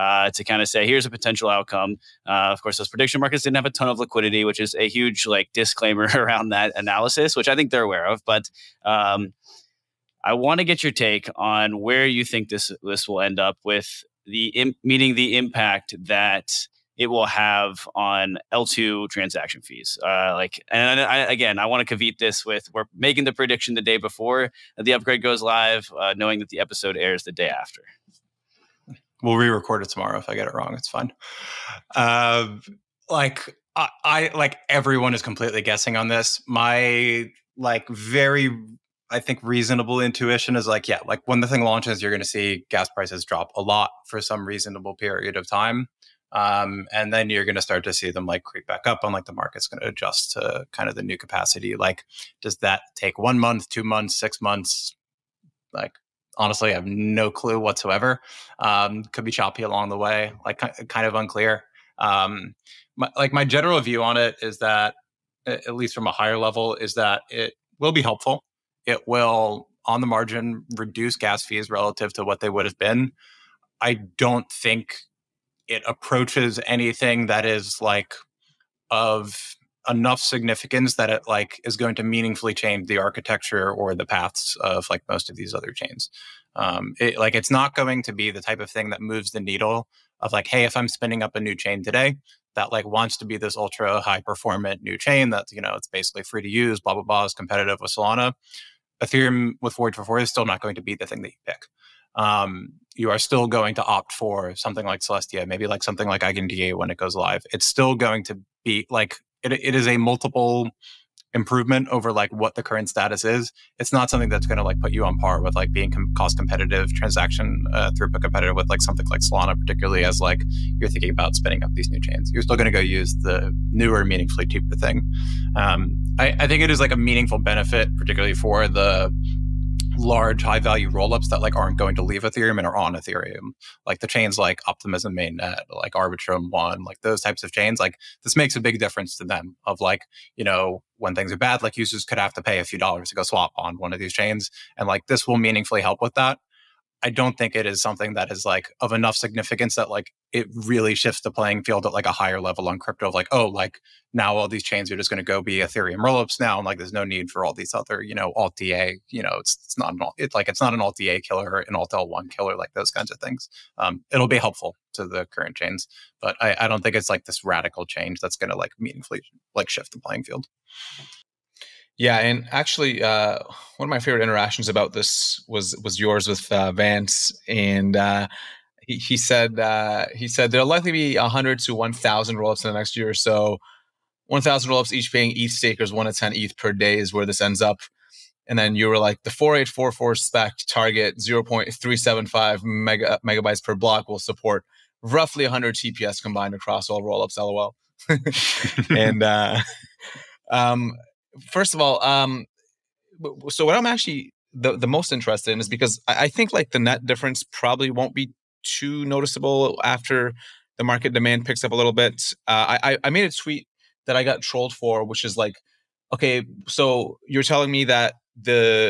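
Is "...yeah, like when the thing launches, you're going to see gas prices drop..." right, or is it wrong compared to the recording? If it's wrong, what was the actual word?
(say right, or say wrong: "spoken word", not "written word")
right.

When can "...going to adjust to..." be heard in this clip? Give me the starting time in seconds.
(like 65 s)
49 s.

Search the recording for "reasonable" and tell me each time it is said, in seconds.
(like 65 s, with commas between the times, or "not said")
39 s, 44 s.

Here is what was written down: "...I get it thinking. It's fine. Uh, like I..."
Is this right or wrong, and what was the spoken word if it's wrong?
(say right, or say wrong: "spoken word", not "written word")
wrong: "wrong", not "thinking".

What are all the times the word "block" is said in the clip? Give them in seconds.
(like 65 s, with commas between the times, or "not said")
193 s.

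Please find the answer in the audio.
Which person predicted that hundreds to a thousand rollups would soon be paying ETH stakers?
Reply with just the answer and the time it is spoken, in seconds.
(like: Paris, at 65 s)
Vance, at 176 s.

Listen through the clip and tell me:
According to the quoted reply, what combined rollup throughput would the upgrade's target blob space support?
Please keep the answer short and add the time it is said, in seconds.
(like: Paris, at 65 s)
100 TPS, at 195 s.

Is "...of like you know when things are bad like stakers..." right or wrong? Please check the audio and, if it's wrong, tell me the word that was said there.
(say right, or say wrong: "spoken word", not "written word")
wrong: "users", not "stakers".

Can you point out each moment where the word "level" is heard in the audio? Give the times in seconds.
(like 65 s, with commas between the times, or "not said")
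66 s, 152 s.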